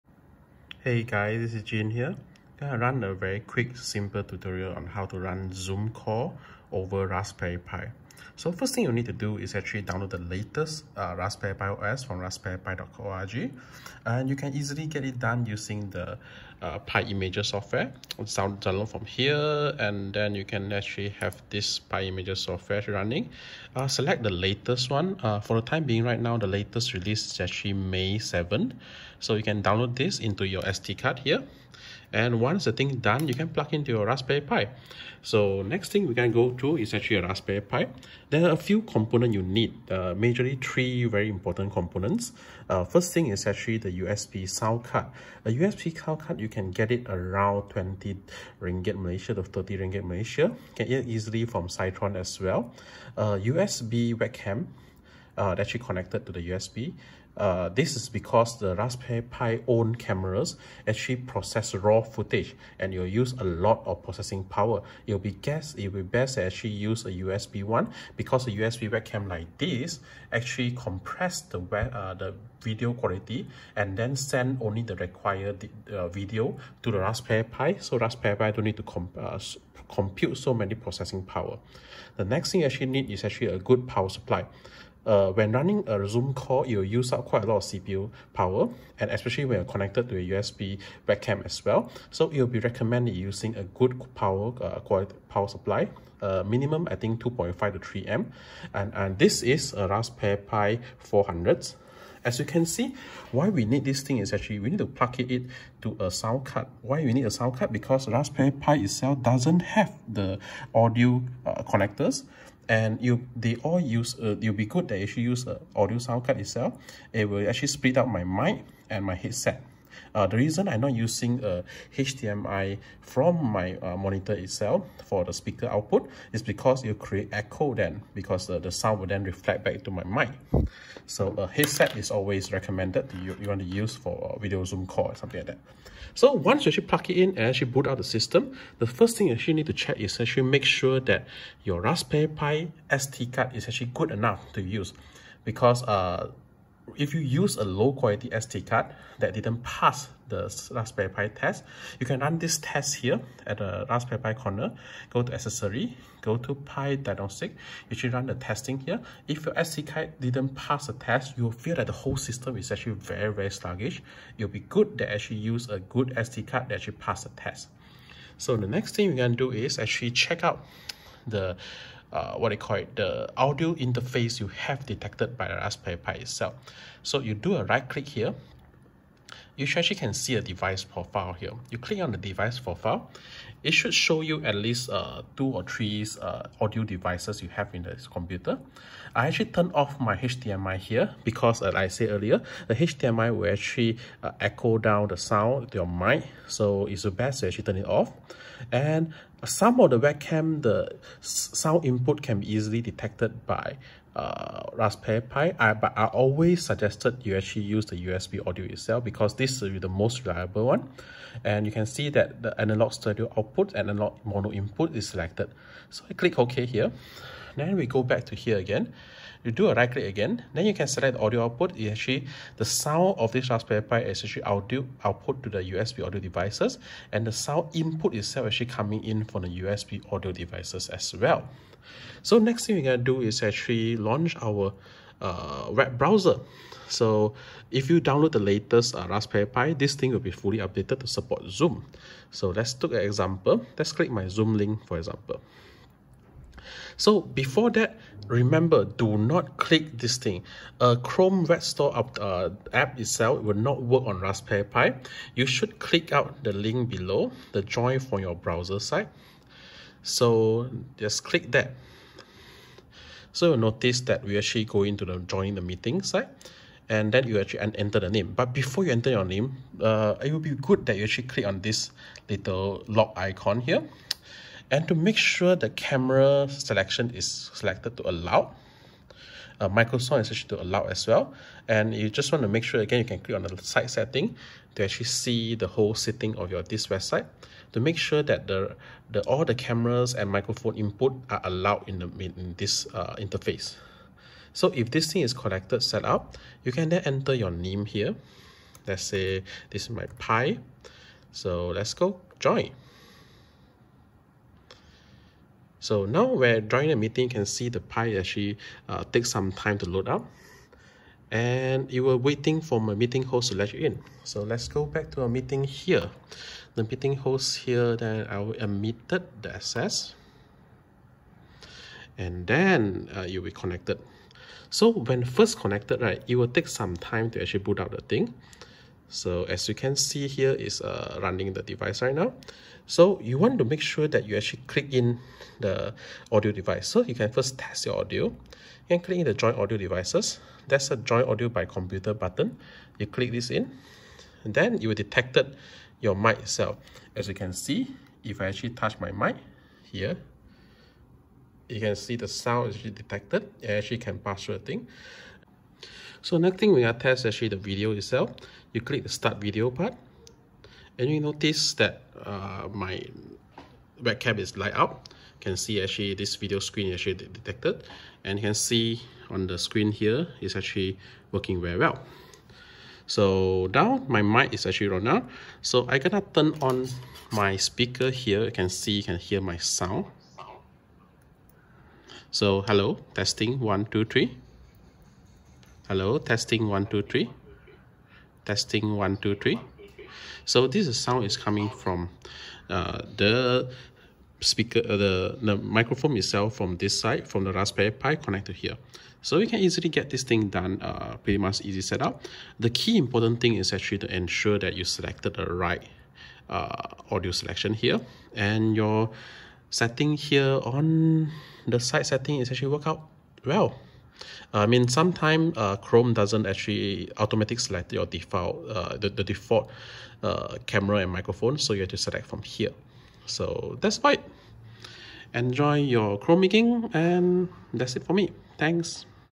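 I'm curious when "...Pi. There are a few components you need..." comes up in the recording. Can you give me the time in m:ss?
0:37.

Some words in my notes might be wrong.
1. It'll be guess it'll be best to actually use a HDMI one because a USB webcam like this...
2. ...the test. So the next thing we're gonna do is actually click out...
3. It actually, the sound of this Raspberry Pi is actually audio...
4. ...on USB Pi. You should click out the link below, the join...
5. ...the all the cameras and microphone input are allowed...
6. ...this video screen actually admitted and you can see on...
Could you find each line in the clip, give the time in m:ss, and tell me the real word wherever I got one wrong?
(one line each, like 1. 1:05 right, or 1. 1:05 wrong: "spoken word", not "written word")
1. 1:05 wrong: "USB", not "HDMI"
2. 2:47 wrong: "check", not "click"
3. 3:41 right
4. 4:14 wrong: "Raspberry", not "USB"
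5. 4:49 right
6. 6:06 wrong: "detected", not "admitted".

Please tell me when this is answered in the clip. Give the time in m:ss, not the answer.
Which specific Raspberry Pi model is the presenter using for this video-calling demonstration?
1:39.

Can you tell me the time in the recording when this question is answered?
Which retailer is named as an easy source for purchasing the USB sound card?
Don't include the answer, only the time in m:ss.
0:51.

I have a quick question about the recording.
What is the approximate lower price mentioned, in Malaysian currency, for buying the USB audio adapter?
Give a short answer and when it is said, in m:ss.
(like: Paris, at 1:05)
20 ringgit, at 0:47.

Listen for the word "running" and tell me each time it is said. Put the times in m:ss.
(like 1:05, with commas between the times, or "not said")
0:22, 1:25, 5:31.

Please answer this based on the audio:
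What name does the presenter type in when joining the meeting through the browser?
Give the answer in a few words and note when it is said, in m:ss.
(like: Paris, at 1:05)
my Pi, at 4:59.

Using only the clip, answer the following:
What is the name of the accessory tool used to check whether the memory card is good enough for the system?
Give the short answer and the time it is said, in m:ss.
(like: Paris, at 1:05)
Pi diagnostic, at 2:36.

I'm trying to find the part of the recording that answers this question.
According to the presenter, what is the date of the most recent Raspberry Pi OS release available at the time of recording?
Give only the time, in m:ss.
0:27.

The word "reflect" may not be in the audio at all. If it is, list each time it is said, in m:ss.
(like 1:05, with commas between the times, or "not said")
2:09.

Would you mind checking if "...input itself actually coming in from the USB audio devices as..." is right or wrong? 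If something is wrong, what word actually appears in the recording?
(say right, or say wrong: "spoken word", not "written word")
right.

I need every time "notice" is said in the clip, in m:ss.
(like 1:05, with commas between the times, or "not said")
4:23, 6:01.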